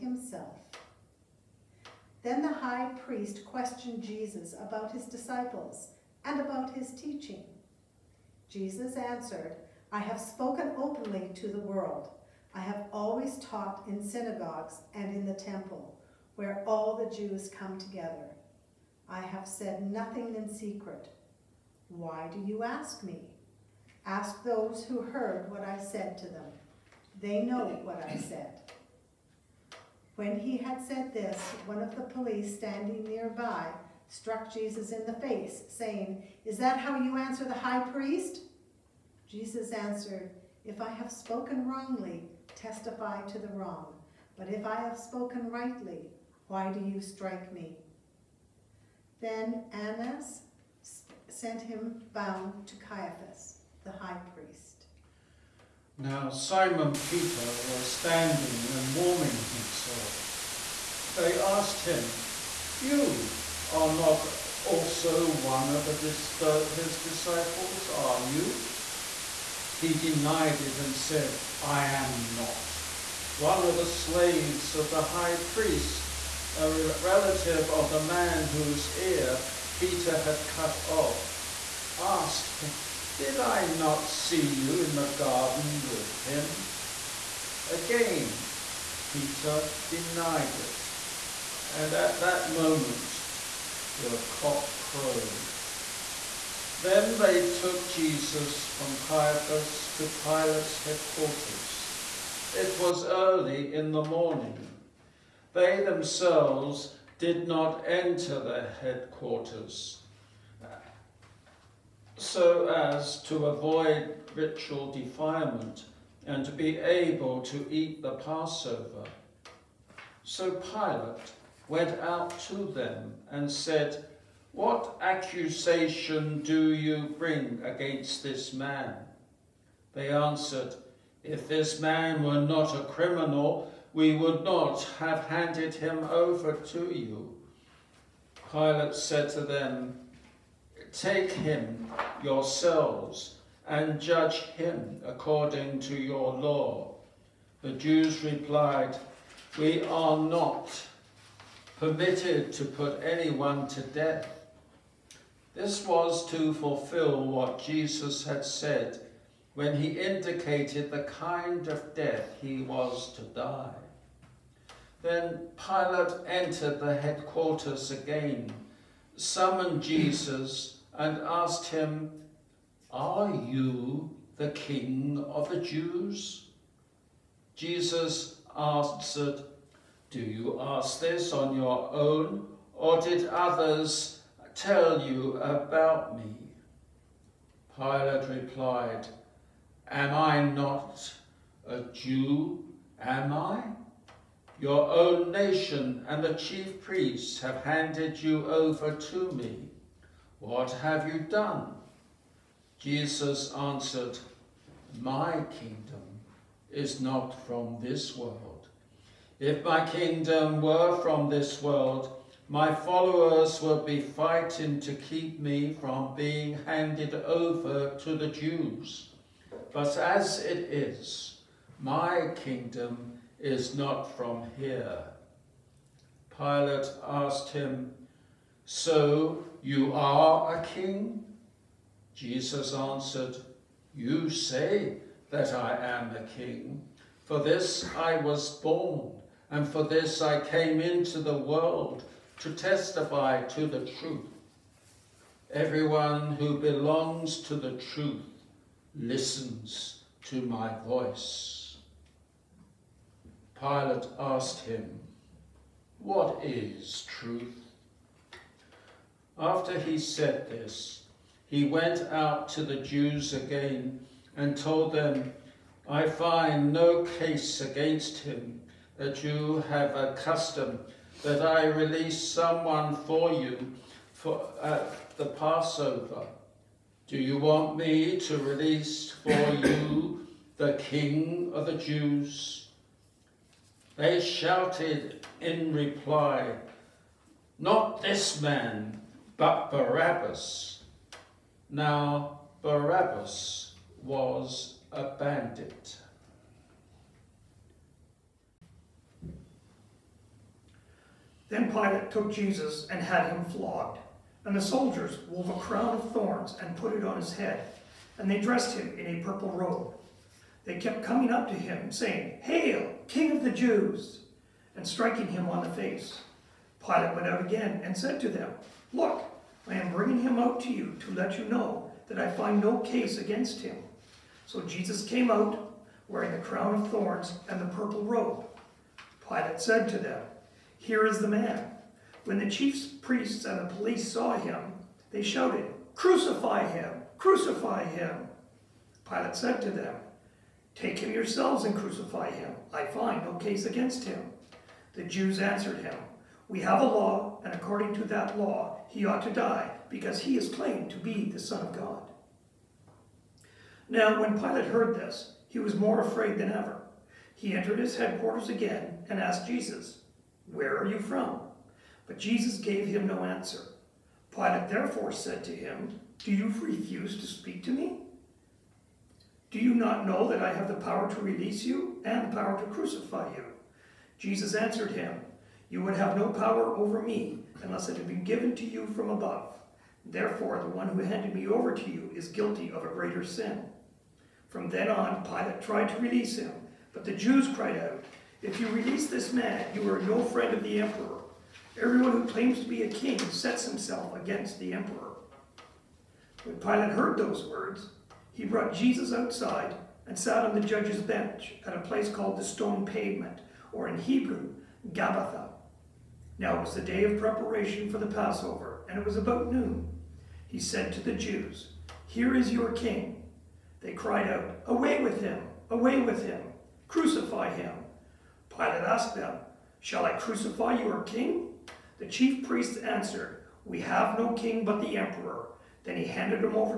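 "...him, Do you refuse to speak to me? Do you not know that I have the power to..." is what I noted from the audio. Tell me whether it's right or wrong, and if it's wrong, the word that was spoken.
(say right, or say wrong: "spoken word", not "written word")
right.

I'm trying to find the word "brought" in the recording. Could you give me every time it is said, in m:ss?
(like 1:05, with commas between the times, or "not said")
6:38.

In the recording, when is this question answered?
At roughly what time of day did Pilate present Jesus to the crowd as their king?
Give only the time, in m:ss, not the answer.
6:49.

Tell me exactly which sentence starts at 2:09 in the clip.
They answered, If this man were not a criminal, we would not have handed him over to you.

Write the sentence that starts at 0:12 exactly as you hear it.
I have always taught in synagogues and in the temple, where all the Jews come together.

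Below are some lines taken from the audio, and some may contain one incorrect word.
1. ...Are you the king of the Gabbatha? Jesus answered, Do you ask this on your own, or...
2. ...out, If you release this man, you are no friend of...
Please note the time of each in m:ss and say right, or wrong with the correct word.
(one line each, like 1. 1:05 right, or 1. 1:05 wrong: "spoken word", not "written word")
1. 2:52 wrong: "Jews", not "Gabbatha"
2. 6:27 right.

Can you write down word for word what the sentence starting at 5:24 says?
So Jesus came out, wearing the crown of thorns and the purple robe.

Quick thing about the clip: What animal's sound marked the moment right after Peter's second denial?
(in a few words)
The cock.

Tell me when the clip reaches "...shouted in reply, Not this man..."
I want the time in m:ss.
4:44.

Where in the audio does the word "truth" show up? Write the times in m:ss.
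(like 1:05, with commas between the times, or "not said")
4:03, 4:07, 4:17.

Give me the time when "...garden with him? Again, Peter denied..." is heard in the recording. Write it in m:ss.
1:25.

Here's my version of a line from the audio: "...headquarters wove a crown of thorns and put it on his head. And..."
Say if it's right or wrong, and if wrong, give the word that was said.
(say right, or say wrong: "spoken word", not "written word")
wrong: "soldiers", not "headquarters".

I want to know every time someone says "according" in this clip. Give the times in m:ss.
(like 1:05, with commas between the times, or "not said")
2:25, 5:47.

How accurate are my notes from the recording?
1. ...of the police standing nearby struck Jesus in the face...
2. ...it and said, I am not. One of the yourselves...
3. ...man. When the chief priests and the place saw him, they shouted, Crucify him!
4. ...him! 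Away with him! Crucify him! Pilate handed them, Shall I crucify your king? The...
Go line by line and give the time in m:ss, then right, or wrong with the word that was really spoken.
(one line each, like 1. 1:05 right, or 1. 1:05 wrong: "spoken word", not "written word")
1. 0:31 right
2. 1:10 wrong: "slaves", not "yourselves"
3. 5:31 wrong: "police", not "place"
4. 6:55 wrong: "asked", not "handed".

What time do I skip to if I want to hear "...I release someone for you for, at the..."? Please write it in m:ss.
4:31.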